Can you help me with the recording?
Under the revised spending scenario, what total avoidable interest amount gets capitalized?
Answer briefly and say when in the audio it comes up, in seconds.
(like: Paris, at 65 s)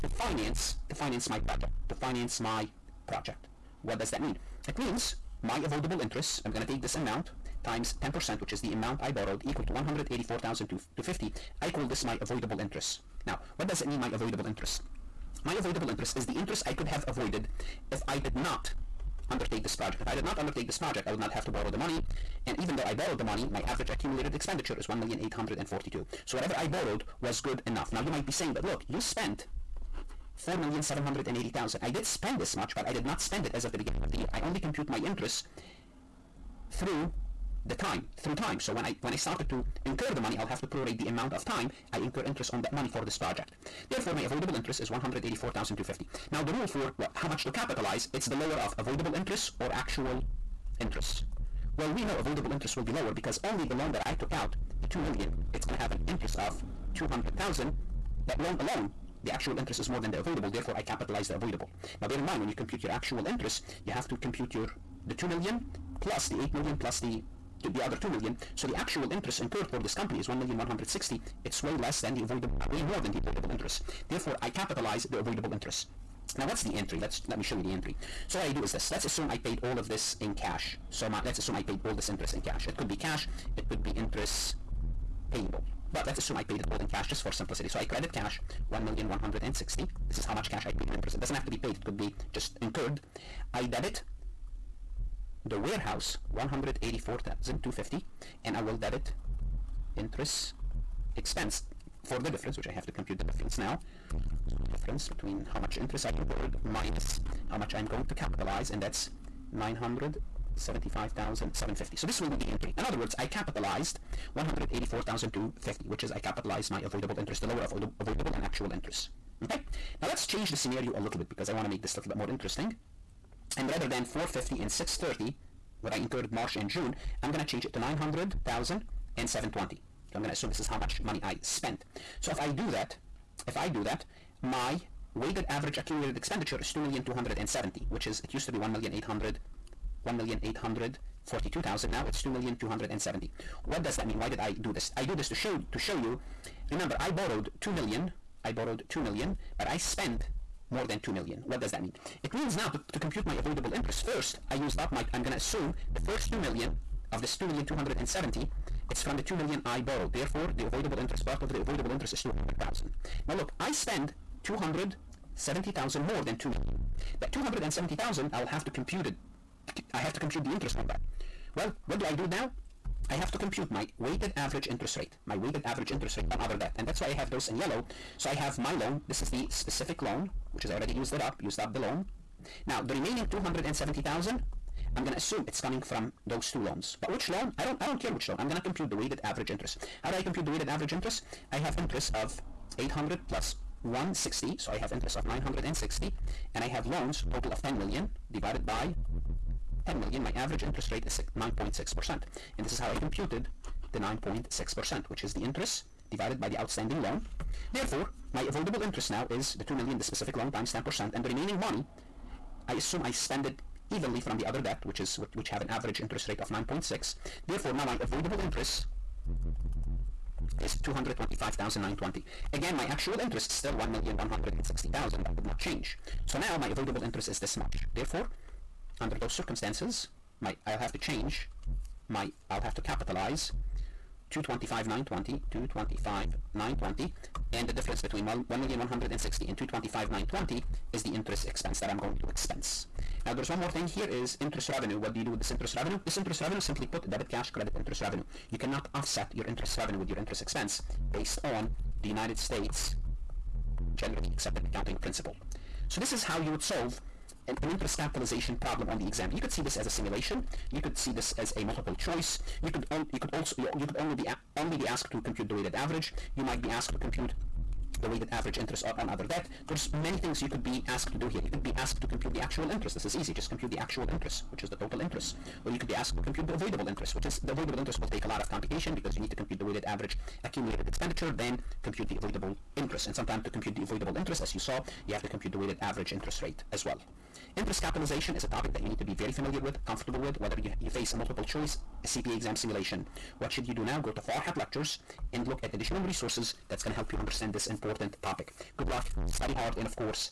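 225,920, at 220 s.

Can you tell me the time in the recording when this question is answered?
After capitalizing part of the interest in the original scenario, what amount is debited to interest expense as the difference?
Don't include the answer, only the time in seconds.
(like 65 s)
109 s.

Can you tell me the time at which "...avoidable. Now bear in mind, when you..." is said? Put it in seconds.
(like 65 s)
61 s.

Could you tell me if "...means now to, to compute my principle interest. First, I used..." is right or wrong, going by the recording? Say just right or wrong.
wrong.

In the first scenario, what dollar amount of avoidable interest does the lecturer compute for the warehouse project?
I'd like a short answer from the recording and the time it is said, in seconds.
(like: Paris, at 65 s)
184,250, at 9 s.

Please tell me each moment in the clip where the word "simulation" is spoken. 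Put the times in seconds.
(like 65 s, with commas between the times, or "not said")
259 s, 292 s.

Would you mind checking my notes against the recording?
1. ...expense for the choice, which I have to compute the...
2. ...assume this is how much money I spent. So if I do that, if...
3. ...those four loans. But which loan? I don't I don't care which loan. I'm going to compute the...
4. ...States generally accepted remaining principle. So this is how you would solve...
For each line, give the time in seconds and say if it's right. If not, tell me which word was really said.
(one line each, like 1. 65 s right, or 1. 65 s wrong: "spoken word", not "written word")
1. 101 s wrong: "difference", not "choice"
2. 130 s right
3. 186 s wrong: "two", not "four"
4. 252 s wrong: "accounting", not "remaining".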